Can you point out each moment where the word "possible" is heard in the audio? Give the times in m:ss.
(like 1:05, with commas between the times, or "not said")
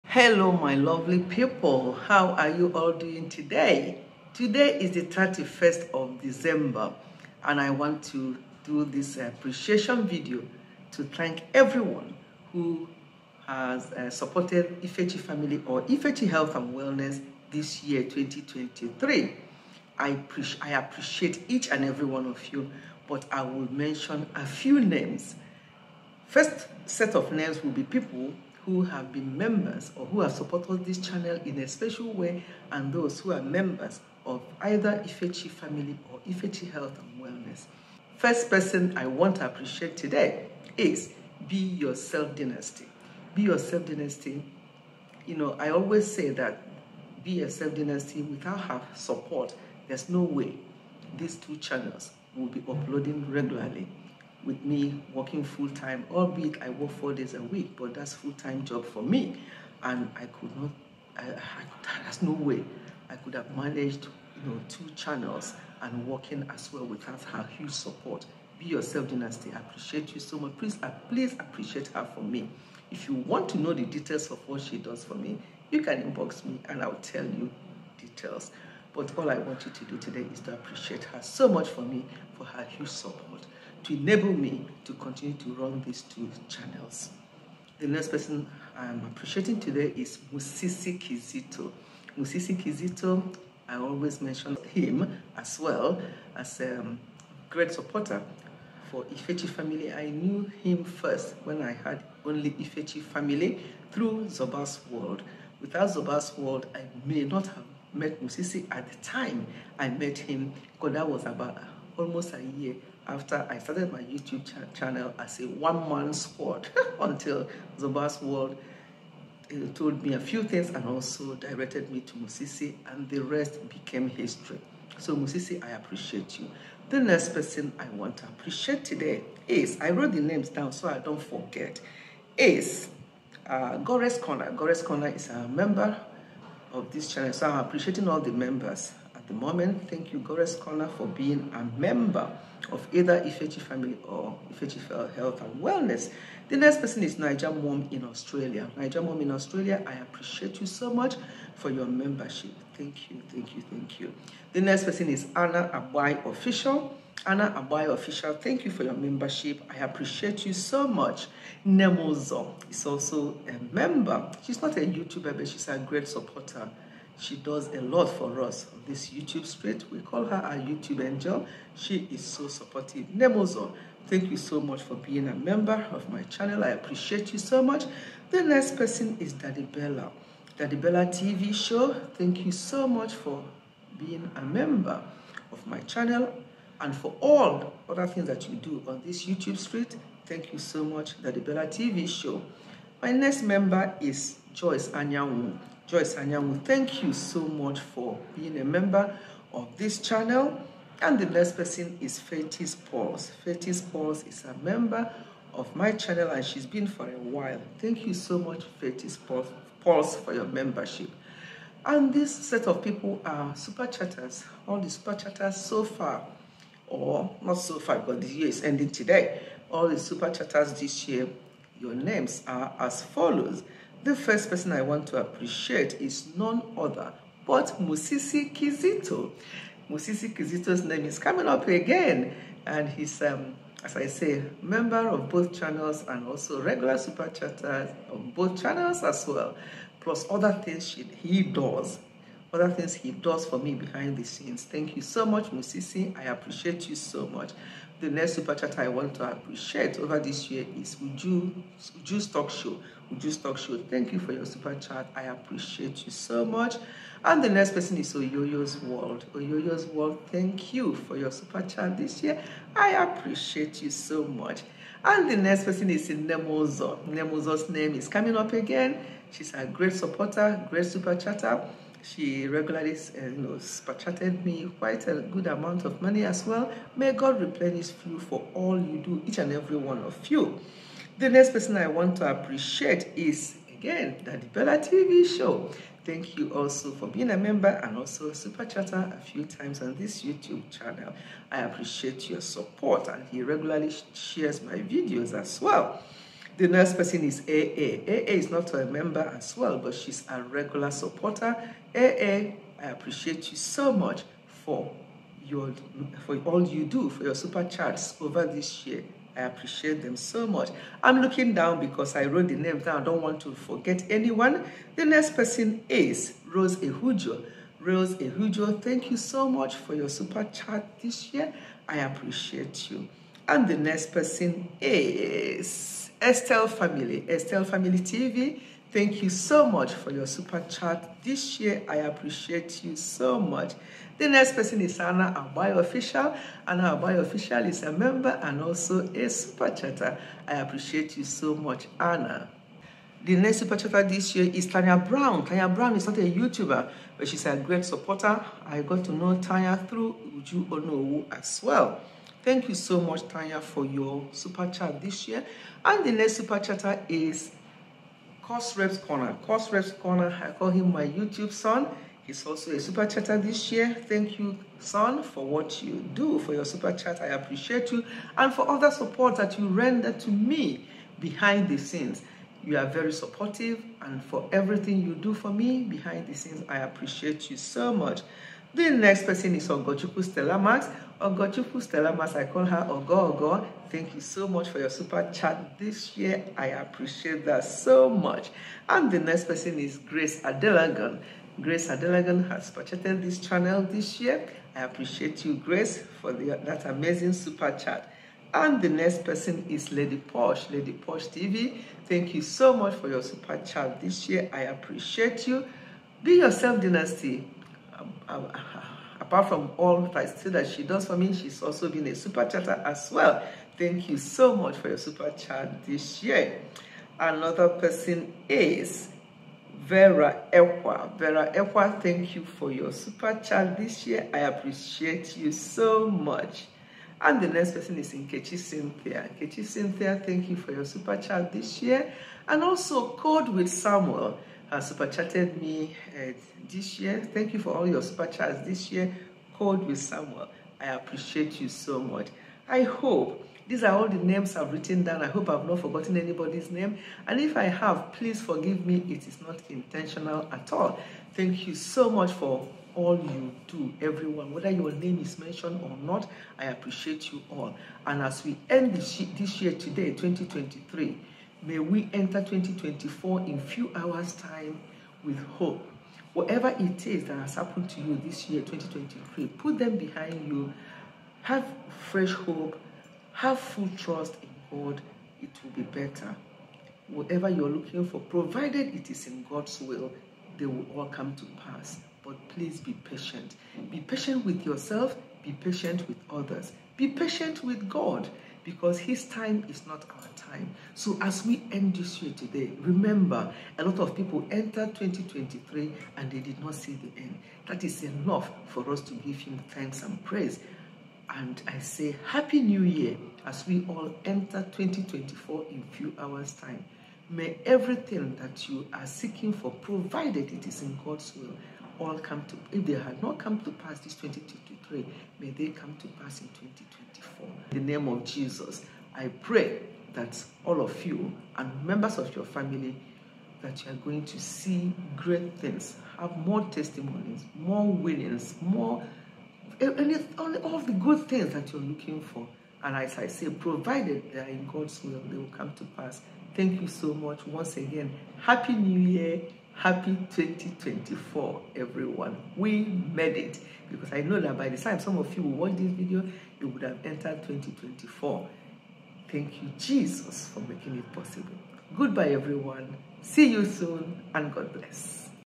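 9:11.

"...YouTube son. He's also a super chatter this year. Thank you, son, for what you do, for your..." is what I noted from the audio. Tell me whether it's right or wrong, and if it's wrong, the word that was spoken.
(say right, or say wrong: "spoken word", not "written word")
right.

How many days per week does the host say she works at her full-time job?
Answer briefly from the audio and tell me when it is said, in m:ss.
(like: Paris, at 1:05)
4, at 0:56.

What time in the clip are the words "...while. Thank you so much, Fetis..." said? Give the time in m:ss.
3:27.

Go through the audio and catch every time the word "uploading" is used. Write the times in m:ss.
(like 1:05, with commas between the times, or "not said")
0:52.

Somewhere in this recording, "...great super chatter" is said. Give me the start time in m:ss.
4:30.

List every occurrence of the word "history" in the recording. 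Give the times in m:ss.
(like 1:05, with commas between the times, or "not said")
2:04.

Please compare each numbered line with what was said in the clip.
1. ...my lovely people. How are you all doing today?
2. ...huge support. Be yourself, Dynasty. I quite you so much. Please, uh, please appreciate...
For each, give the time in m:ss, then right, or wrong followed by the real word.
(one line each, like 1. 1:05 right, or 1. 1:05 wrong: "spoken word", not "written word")
1. 0:00 right
2. 1:07 wrong: "appreciate", not "quite".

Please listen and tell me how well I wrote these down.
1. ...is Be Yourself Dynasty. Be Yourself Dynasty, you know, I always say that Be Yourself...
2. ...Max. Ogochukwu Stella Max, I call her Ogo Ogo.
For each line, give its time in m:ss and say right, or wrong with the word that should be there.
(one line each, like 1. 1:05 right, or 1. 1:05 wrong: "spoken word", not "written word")
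1. 0:40 right
2. 6:20 right.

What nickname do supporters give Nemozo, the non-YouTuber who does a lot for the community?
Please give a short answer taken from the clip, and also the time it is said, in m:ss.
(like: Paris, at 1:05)
YouTube angel, at 2:50.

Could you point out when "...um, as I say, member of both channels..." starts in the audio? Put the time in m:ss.
3:53.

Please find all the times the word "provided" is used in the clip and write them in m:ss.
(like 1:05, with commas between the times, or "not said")
7:58, 8:29, 8:53.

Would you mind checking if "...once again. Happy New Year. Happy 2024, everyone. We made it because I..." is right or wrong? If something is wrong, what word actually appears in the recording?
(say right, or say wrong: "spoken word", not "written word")
right.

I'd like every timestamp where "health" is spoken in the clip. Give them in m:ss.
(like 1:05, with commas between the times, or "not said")
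0:16, 0:36, 2:25.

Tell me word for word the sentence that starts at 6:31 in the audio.
Grace Adelagan has purchased this channel this year.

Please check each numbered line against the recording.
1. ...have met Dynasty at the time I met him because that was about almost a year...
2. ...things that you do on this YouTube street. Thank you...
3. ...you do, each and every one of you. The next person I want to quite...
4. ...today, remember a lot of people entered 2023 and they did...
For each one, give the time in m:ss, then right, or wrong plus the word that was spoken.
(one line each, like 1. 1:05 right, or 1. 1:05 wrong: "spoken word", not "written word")
1. 1:47 wrong: "Musisi", not "Dynasty"
2. 3:08 right
3. 4:38 wrong: "appreciate", not "quite"
4. 8:12 right.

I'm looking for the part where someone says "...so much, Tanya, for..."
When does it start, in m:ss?
5:52.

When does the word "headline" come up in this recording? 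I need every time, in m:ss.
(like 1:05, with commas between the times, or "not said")
not said.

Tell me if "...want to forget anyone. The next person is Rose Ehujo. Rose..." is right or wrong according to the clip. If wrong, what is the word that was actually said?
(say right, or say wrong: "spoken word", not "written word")
right.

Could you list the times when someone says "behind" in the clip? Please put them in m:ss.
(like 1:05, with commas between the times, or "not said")
4:03, 6:11, 6:15, 7:49.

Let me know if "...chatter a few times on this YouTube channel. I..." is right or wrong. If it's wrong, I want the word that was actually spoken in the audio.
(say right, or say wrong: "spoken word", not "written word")
right.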